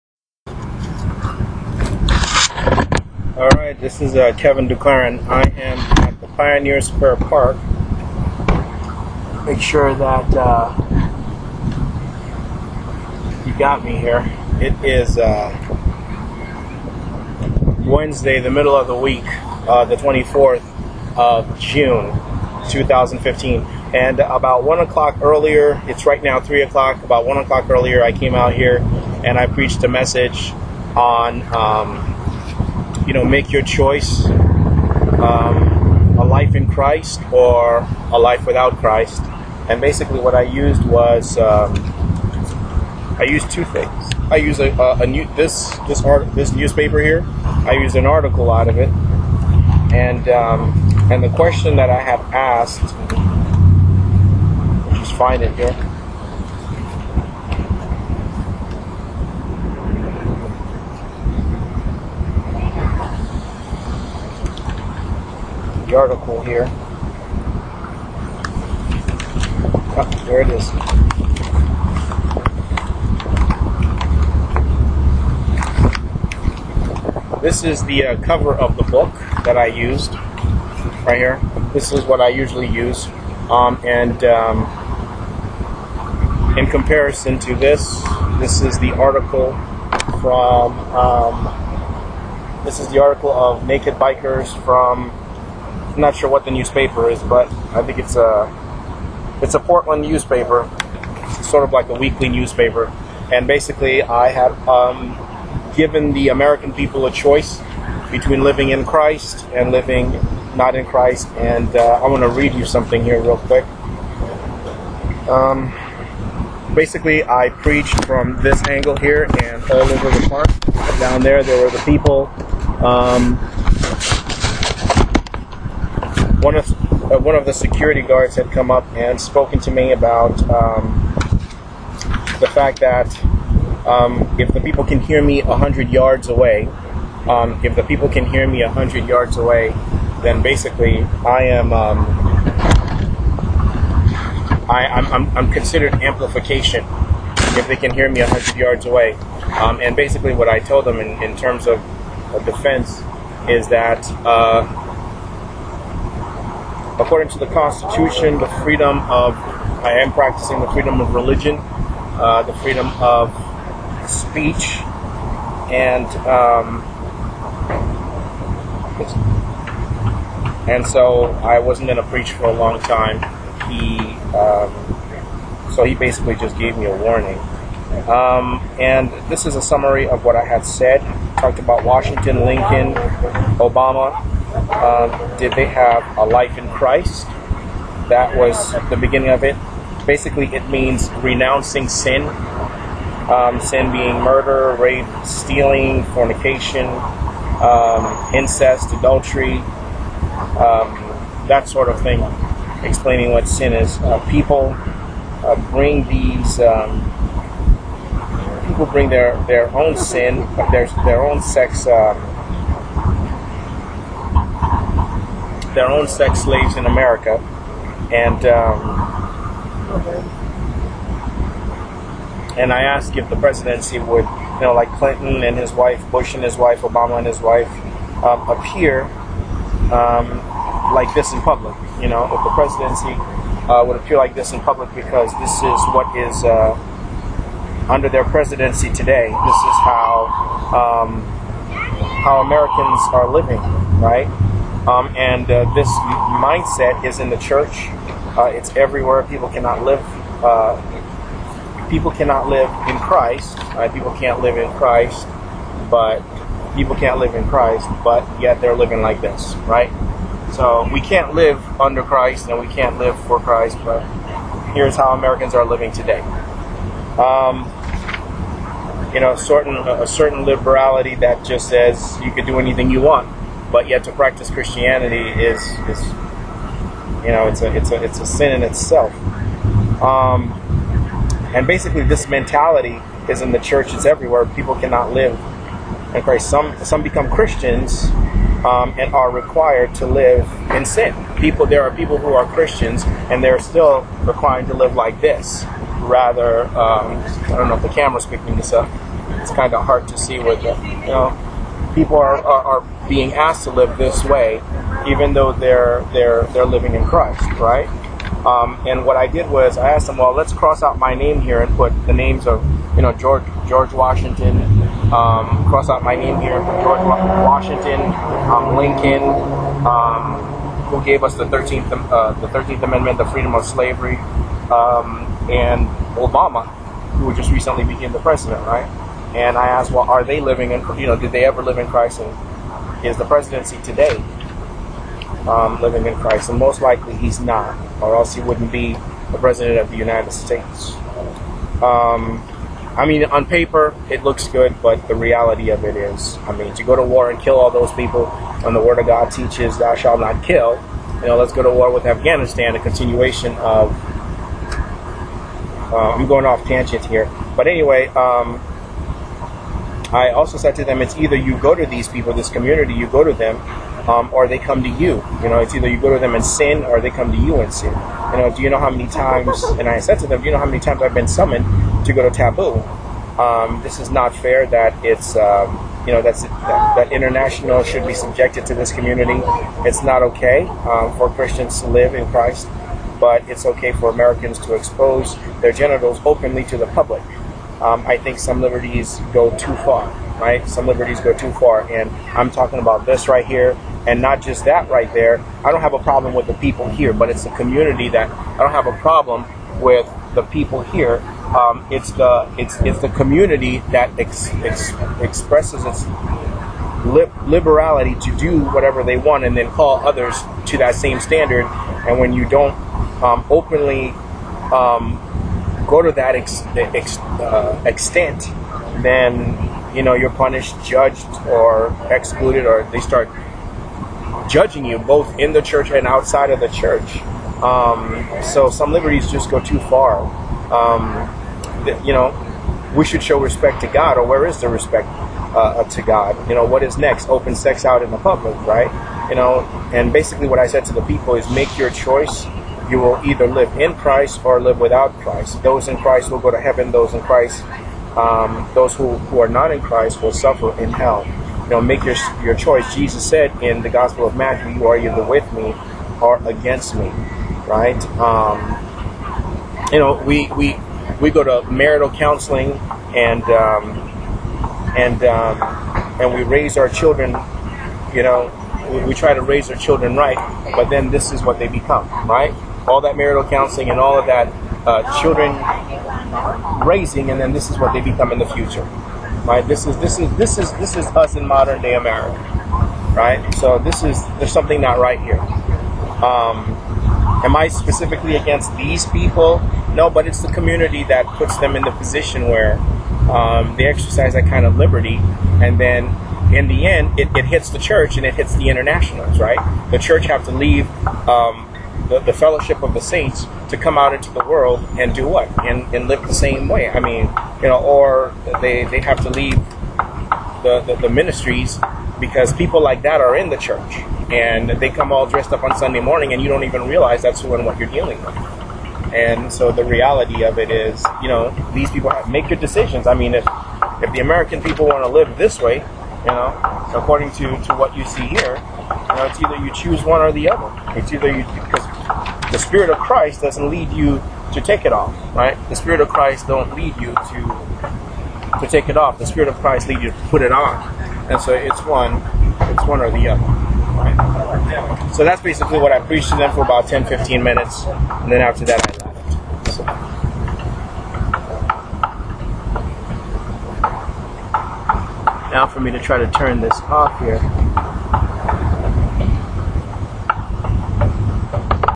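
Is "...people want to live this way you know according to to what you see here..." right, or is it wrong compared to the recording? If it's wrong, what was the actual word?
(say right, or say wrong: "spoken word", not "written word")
right.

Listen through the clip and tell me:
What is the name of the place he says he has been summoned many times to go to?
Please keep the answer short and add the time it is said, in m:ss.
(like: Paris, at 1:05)
Taboo, at 6:12.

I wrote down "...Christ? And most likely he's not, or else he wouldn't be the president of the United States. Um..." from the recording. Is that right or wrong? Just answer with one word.
right.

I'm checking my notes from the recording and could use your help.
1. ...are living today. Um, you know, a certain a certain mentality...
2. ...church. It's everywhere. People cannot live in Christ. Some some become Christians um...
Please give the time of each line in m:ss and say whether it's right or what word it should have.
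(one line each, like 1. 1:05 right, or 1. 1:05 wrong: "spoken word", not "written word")
1. 4:25 wrong: "liberality", not "mentality"
2. 4:43 right.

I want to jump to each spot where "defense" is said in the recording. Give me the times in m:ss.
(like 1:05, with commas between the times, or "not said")
2:32.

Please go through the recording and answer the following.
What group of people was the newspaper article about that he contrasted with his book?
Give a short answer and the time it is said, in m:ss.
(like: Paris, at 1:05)
Naked Bikers, at 1:33.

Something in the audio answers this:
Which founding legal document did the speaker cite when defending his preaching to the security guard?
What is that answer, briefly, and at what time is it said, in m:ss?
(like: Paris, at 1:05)
the Constitution, at 2:37.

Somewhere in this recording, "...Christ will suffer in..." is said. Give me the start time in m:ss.
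7:29.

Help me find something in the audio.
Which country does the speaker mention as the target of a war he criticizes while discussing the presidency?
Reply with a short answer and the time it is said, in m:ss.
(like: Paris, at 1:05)
Afghanistan, at 5:52.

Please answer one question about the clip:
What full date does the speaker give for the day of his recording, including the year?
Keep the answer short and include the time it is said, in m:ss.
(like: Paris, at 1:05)
June 24, 2015, at 0:19.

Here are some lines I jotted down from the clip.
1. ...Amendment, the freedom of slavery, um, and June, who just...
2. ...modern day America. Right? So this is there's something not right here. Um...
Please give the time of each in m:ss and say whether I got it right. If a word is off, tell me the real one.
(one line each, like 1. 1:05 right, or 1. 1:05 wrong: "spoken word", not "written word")
1. 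5:22 wrong: "Obama", not "June"
2. 8:01 right.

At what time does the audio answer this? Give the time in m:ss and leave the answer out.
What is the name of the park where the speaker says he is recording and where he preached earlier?
0:06.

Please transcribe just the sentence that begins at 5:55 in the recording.
Uh, I'm going off tangent here.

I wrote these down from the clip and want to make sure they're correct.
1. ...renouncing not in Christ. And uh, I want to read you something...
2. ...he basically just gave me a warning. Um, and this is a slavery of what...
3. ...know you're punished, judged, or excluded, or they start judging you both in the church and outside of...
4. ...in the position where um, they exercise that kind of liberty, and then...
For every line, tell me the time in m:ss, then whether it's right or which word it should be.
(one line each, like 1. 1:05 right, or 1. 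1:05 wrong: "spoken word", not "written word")
1. 1:49 wrong: "living", not "renouncing"
2. 2:55 wrong: "summary", not "slavery"
3. 7:00 right
4. 8:11 right.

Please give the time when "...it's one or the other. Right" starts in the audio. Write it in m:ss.
9:02.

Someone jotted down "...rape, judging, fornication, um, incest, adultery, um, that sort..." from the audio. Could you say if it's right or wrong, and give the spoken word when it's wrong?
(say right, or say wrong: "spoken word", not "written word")
wrong: "stealing", not "judging".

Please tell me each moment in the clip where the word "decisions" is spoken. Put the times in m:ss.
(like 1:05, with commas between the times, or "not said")
8:42.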